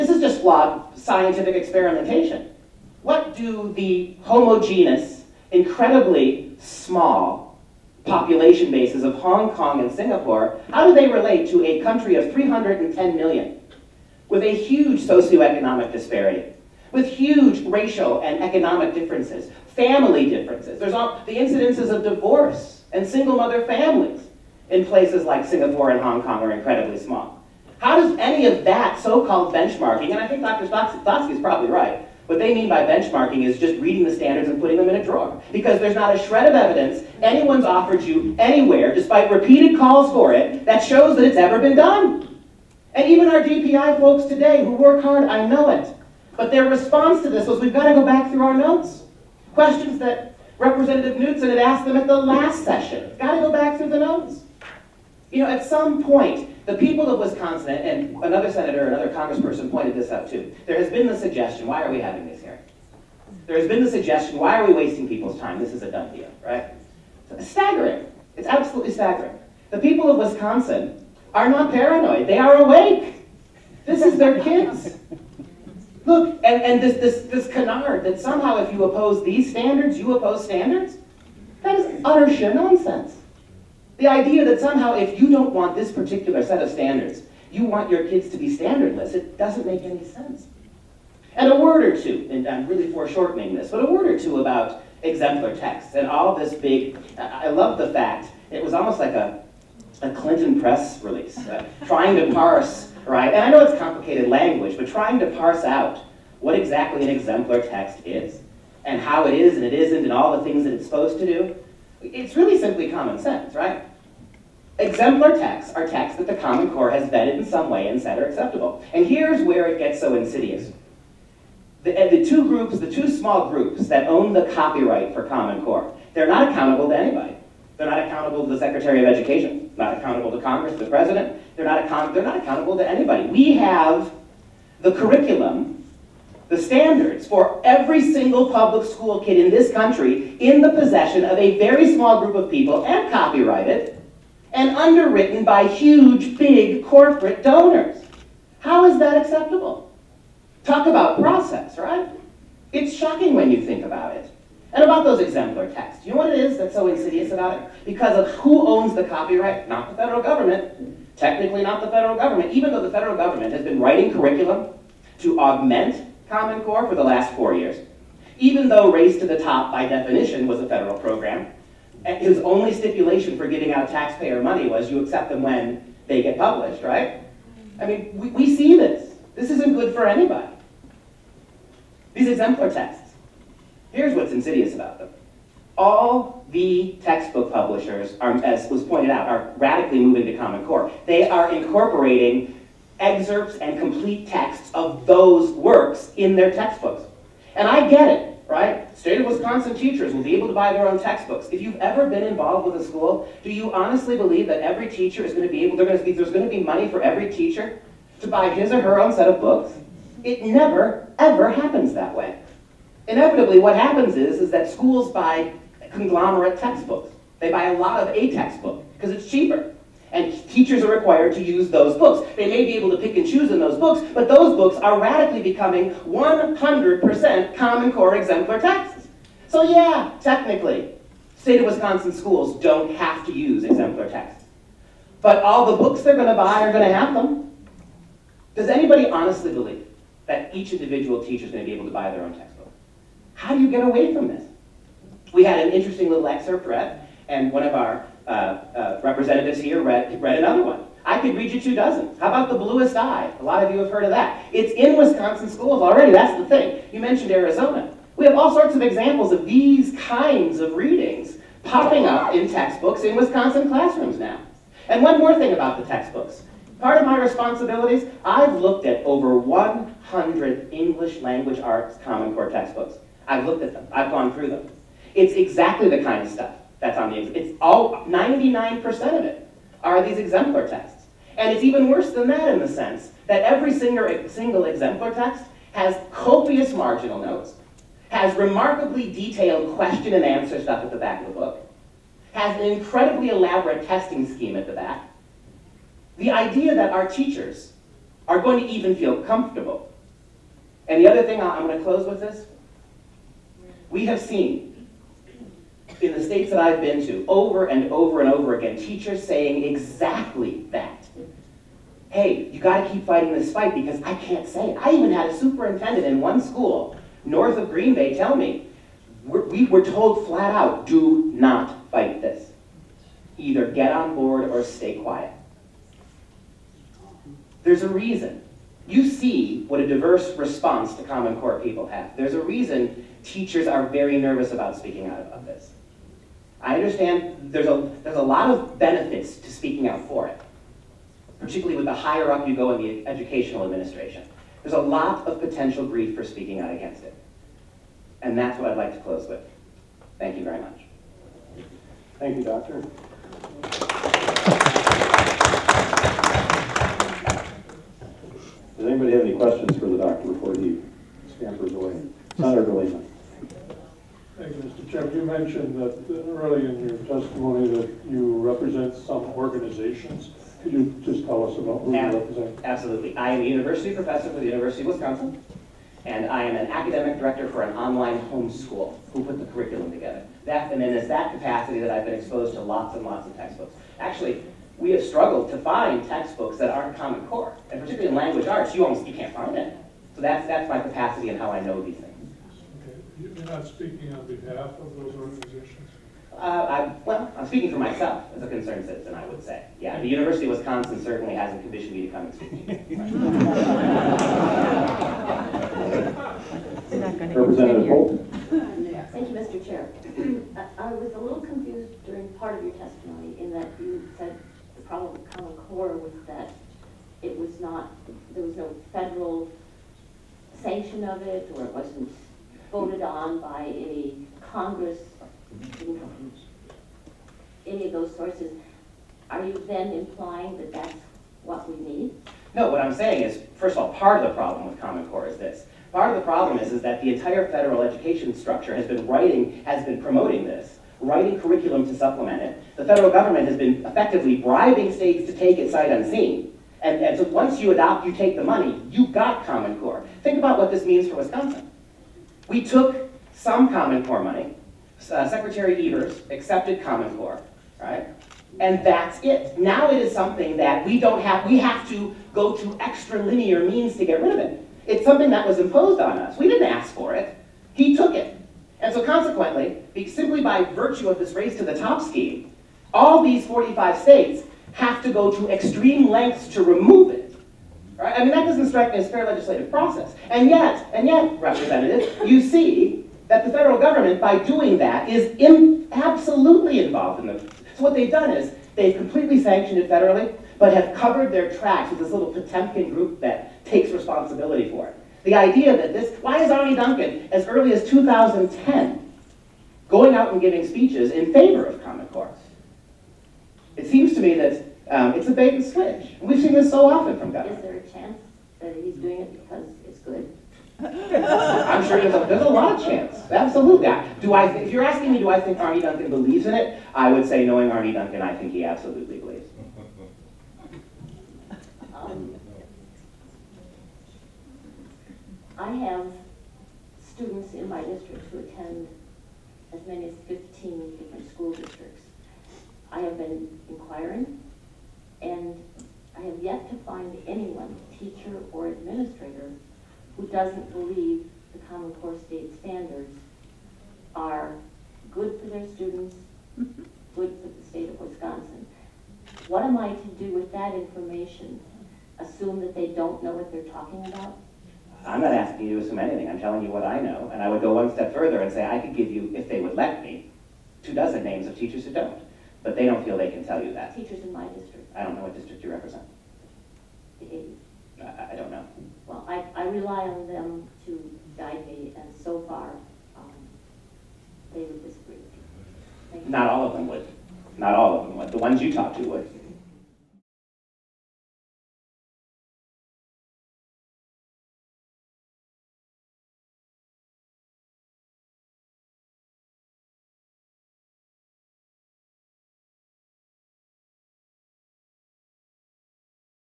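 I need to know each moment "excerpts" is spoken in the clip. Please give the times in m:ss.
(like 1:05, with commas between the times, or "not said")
3:12, 4:06.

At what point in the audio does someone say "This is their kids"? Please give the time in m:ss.
1:13.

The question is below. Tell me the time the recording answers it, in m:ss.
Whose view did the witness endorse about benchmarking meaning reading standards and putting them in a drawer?
0:30.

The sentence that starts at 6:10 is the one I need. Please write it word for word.
Could you just tell us about who you represent?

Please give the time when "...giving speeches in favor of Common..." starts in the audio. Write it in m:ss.
8:20.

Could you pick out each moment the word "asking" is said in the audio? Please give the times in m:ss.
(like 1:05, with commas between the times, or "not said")
8:34, 9:15.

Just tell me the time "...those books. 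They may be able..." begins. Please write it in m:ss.
3:41.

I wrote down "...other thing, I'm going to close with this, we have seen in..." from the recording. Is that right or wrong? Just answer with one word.
right.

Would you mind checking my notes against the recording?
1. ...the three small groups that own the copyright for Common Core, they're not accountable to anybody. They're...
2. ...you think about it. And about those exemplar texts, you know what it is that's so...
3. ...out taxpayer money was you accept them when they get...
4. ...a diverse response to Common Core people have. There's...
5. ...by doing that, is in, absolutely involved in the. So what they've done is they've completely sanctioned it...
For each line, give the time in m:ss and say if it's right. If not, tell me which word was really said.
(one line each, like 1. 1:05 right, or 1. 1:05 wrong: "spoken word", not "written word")
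1. 2:02 wrong: "two", not "three"
2. 2:33 right
3. 2:53 right
4. 5:29 right
5. 8:04 right.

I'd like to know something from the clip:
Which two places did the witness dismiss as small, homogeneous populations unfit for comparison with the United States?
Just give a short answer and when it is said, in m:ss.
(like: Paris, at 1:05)
Hong Kong and Singapore, at 0:09.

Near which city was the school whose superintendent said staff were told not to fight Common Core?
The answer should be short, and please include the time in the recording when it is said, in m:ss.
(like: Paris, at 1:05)
Green Bay, at 5:17.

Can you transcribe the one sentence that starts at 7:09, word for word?
Are you then implying that that's what we need?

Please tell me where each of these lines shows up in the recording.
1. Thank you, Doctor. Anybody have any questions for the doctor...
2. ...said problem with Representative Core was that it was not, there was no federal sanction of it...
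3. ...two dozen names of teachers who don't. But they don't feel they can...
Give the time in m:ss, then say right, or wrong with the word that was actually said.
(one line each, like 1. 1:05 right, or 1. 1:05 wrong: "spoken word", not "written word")
1. 5:52 right
2. 6:54 wrong: "Common", not "Representative"
3. 9:20 right.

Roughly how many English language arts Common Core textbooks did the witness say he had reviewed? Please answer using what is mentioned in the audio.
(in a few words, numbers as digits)
over 100.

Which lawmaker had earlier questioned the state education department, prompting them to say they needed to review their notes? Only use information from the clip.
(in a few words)
Representative Knudson.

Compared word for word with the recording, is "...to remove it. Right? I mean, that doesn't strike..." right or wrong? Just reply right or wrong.
right.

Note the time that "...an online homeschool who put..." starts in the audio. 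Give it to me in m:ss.
6:17.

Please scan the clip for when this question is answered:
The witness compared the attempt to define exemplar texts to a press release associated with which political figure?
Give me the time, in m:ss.
1:40.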